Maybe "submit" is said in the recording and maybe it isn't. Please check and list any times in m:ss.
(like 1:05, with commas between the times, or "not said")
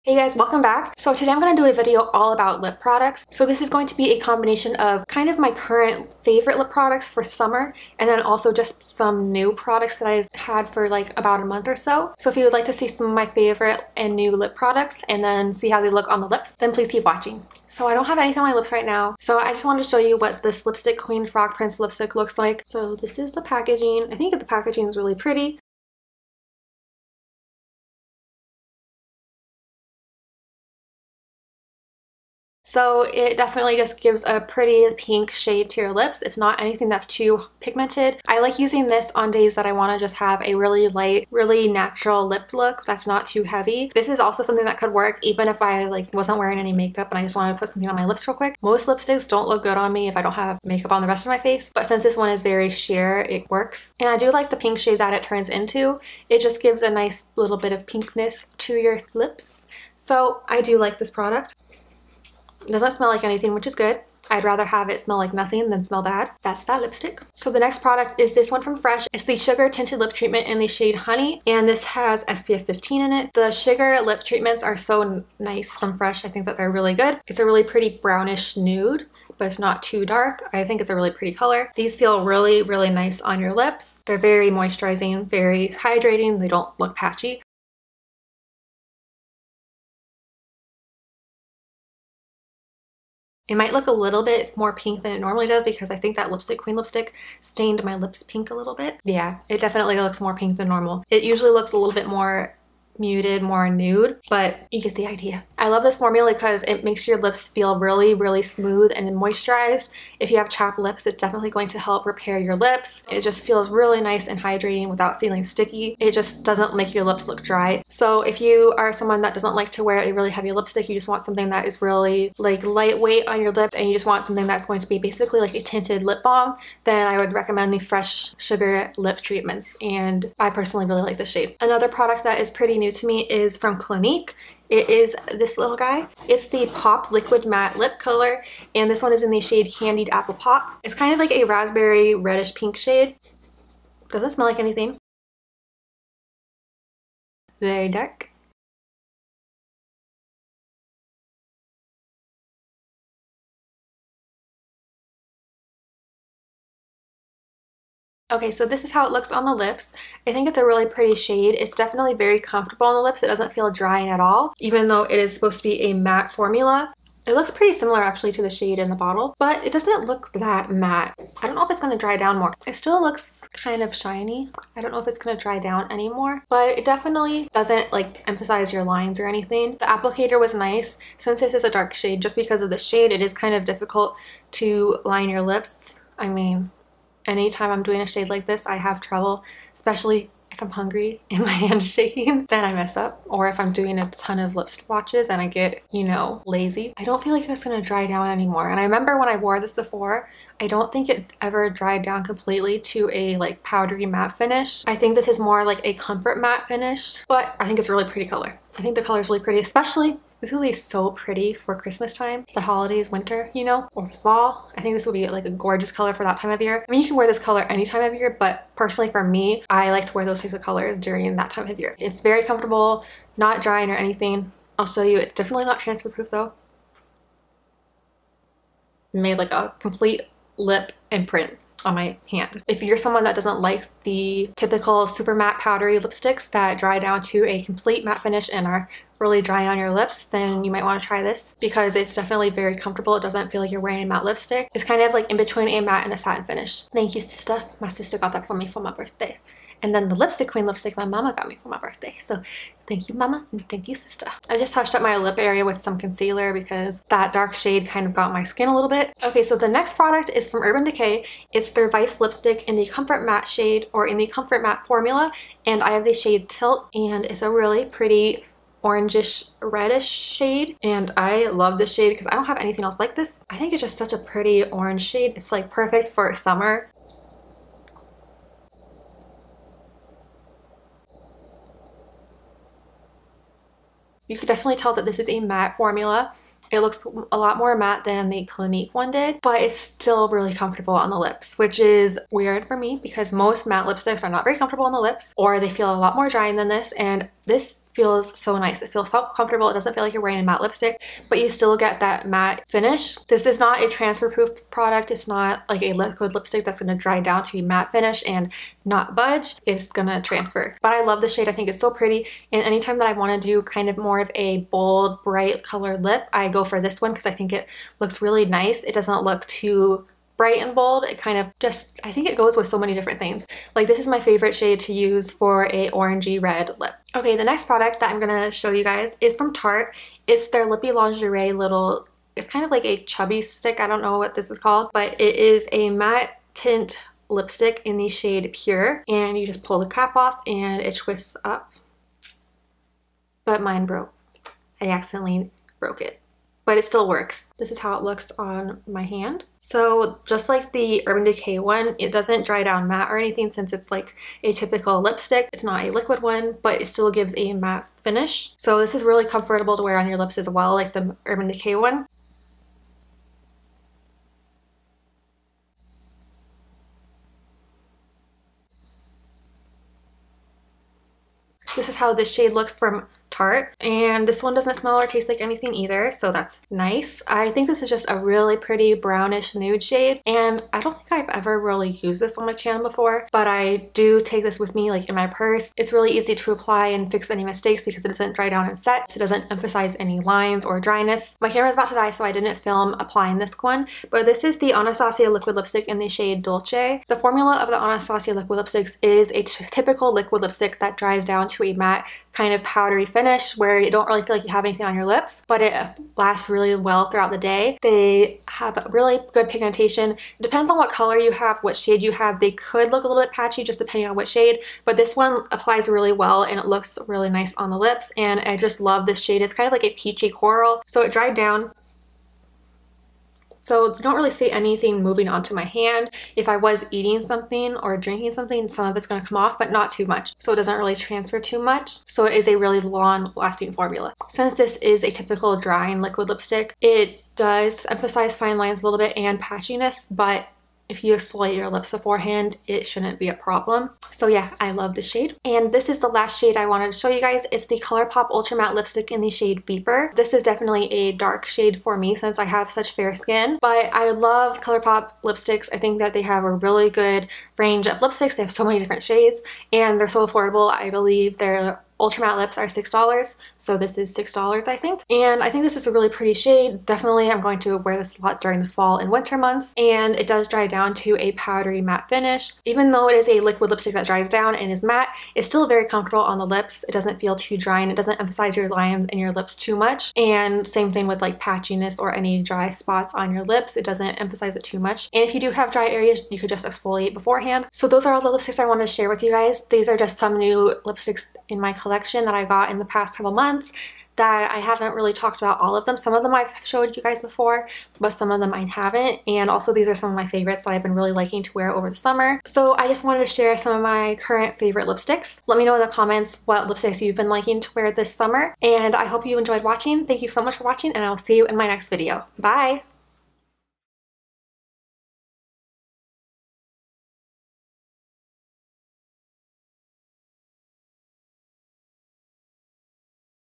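not said.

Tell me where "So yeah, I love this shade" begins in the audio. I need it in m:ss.
7:24.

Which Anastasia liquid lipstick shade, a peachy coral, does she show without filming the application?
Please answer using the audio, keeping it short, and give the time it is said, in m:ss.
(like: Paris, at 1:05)
Dolce, at 6:36.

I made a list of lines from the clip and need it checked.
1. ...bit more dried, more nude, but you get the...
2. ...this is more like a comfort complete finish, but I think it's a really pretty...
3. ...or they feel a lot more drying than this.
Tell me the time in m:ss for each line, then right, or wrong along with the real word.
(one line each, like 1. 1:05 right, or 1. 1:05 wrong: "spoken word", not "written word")
1. 1:41 wrong: "muted", not "dried"
2. 3:25 wrong: "matte", not "complete"
3. 4:55 right.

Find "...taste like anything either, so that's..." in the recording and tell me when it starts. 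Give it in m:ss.
6:15.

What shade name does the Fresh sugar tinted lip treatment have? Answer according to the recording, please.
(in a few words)
Honey.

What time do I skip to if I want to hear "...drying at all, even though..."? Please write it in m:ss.
2:43.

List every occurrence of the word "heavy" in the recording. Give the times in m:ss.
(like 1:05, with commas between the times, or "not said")
0:43, 2:00.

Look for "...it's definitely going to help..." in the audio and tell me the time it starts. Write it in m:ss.
1:51.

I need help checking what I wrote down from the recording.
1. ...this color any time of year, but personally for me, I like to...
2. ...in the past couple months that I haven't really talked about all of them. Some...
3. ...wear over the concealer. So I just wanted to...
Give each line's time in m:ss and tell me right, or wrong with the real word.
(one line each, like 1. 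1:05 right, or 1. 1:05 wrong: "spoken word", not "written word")
1. 3:37 right
2. 8:12 right
3. 8:21 wrong: "summer", not "concealer".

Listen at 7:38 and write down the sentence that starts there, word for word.
They have so many different shades and they're so affordable.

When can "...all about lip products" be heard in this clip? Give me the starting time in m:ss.
0:02.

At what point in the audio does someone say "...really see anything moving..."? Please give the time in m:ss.
7:04.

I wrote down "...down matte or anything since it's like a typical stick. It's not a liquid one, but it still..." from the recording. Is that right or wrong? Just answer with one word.
wrong.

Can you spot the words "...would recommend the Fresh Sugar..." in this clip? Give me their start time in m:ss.
2:07.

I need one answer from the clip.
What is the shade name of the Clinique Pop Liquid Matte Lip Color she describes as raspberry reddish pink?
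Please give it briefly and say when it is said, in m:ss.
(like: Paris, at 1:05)
Candied Apple Pop, at 2:19.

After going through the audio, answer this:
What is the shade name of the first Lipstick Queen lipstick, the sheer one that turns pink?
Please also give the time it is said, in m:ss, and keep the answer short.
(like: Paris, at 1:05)
Frog Prince, at 0:21.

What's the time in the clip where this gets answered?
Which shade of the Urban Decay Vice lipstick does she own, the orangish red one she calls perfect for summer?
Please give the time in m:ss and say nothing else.
4:26.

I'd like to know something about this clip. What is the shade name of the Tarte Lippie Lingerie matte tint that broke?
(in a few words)
Pure.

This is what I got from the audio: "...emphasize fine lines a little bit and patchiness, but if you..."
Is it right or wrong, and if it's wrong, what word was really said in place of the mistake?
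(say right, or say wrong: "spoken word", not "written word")
right.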